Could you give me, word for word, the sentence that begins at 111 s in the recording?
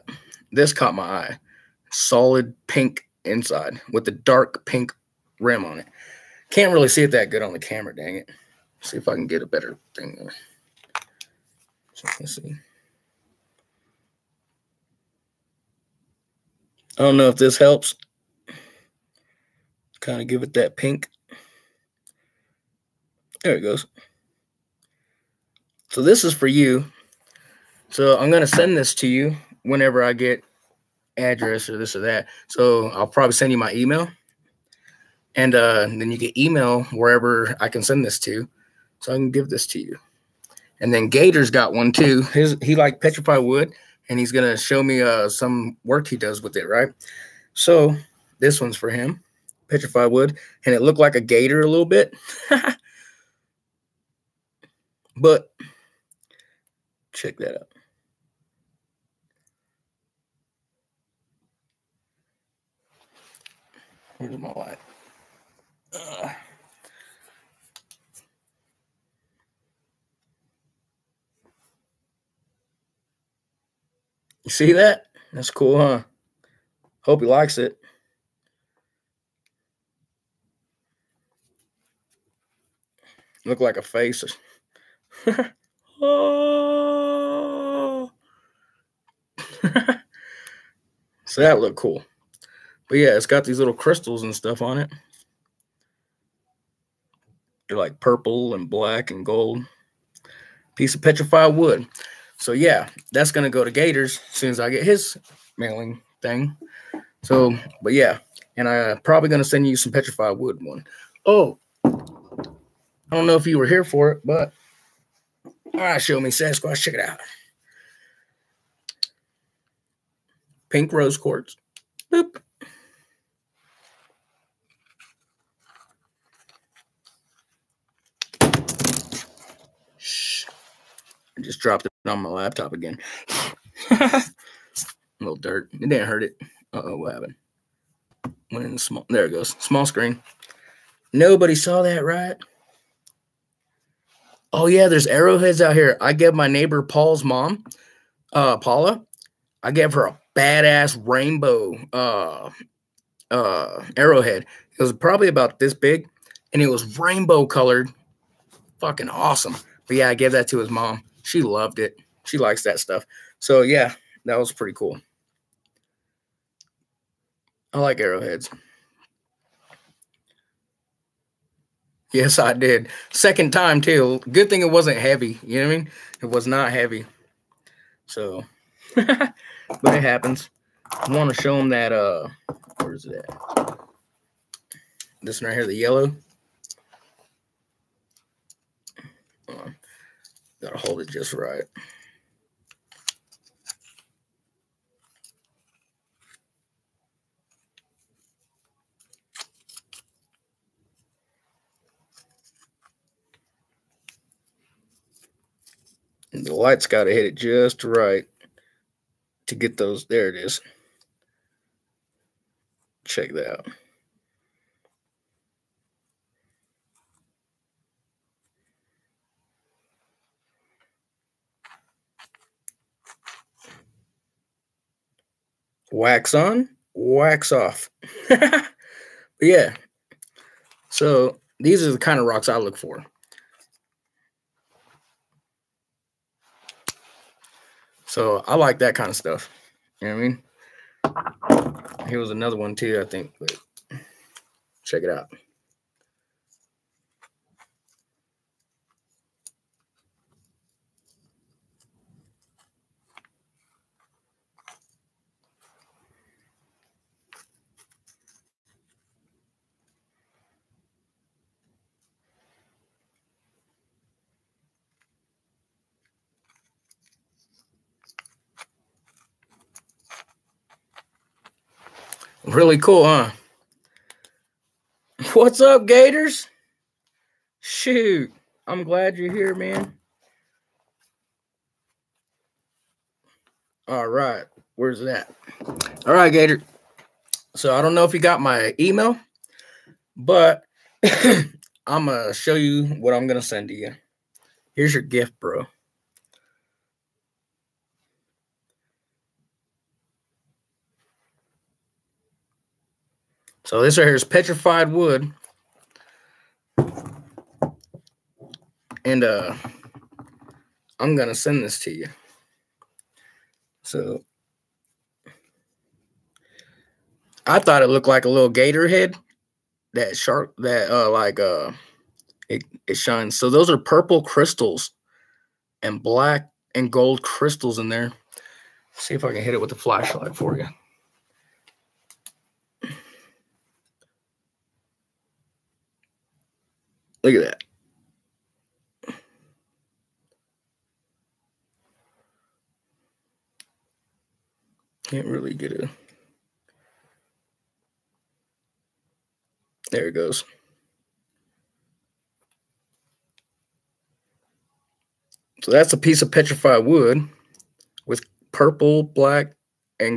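Oh, I don't know if you were here for it, but all right, show me Sasquatch.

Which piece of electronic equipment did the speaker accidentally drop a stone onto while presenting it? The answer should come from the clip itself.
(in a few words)
Laptop.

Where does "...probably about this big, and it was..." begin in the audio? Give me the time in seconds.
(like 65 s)
154 s.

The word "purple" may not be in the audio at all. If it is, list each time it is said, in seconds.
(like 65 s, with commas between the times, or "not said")
97 s, 323 s, 358 s.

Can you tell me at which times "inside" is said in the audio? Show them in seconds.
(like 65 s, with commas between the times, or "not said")
3 s.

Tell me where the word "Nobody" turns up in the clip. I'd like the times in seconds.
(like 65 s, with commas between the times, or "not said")
141 s.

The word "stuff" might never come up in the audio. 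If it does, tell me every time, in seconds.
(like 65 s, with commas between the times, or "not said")
94 s, 162 s, 239 s.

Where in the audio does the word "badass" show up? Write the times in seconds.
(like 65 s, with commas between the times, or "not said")
150 s.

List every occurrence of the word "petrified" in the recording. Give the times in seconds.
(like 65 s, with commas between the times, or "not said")
43 s, 49 s, 101 s, 109 s, 304 s, 356 s.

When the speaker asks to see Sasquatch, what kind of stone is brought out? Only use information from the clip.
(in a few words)
Pink rose quartz.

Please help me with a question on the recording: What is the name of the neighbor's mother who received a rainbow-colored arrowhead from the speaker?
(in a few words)
Paula.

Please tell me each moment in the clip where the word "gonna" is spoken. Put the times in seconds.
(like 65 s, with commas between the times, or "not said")
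44 s, 103 s, 109 s, 311 s.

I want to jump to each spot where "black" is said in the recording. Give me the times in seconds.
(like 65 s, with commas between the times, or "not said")
98 s, 326 s, 359 s.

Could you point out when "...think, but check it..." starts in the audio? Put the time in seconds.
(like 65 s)
243 s.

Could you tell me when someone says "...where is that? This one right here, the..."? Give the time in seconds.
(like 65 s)
182 s.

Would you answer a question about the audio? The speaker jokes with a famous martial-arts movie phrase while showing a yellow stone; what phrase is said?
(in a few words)
Wax on, wax off.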